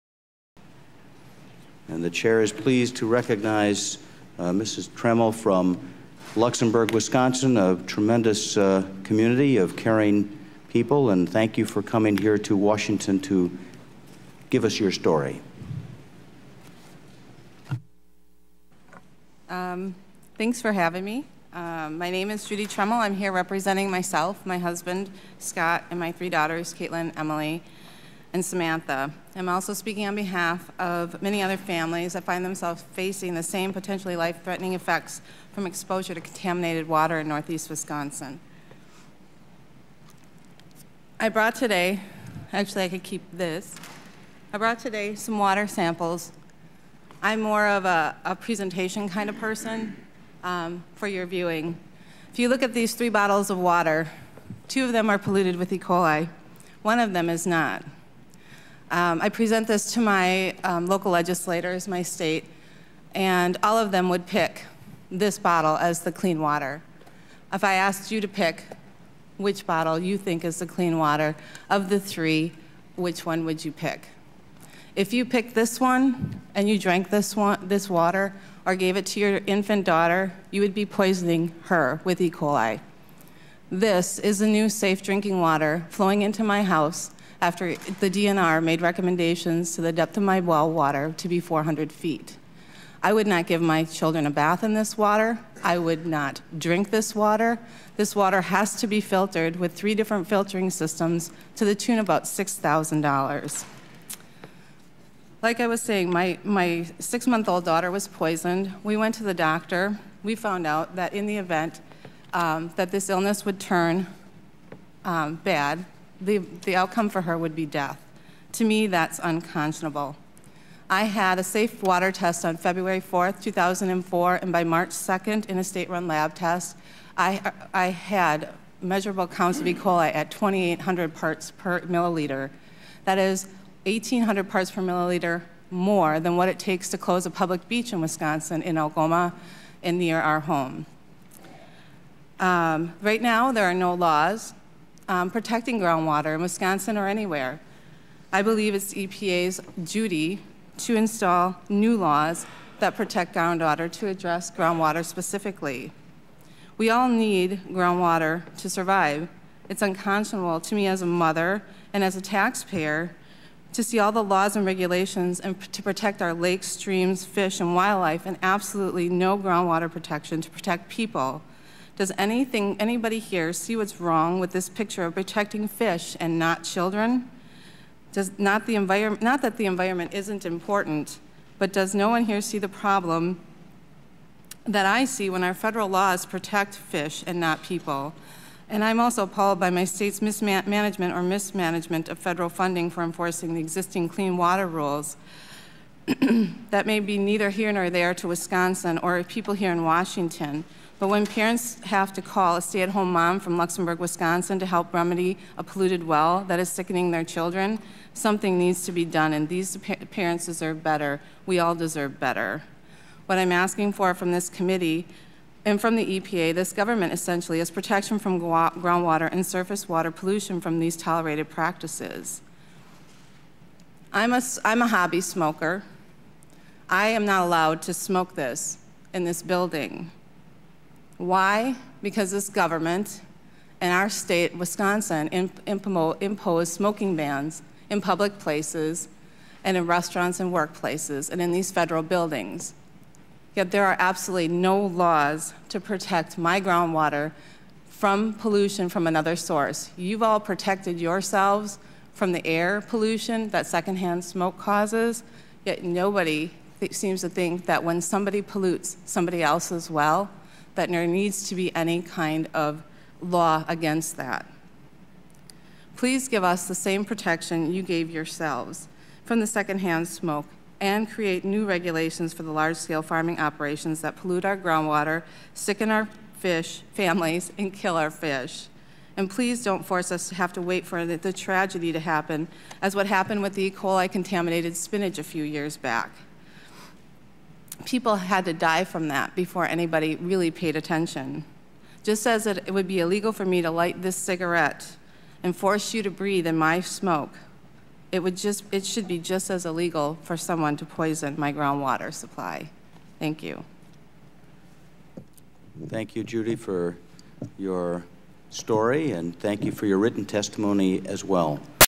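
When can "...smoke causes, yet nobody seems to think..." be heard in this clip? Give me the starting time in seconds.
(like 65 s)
254 s.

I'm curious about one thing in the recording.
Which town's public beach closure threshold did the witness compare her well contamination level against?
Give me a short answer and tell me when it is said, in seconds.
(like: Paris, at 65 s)
Algoma, at 138 s.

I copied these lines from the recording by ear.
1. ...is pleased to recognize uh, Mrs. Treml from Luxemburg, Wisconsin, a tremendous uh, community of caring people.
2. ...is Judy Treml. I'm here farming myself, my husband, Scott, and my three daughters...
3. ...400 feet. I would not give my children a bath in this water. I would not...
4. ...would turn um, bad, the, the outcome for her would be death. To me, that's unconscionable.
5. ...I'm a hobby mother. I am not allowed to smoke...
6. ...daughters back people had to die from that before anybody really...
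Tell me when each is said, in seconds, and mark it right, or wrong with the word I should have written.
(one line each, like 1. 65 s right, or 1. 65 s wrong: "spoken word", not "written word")
1. 2 s right
2. 22 s wrong: "representing", not "farming"
3. 91 s right
4. 113 s right
5. 224 s wrong: "smoker", not "mother"
6. 285 s wrong: "years", not "daughters".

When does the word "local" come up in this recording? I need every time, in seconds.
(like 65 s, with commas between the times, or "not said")
60 s.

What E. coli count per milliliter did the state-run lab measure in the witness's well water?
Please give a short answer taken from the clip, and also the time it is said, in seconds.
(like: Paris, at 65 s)
2,800, at 130 s.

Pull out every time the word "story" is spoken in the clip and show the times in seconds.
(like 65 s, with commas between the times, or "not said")
14 s, 308 s.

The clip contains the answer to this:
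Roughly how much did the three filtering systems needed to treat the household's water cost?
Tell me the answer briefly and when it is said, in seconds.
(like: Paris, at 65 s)
$6,000, at 102 s.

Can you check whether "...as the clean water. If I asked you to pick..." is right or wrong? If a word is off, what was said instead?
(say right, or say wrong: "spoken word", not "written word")
right.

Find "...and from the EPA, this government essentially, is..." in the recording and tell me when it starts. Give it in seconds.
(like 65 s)
215 s.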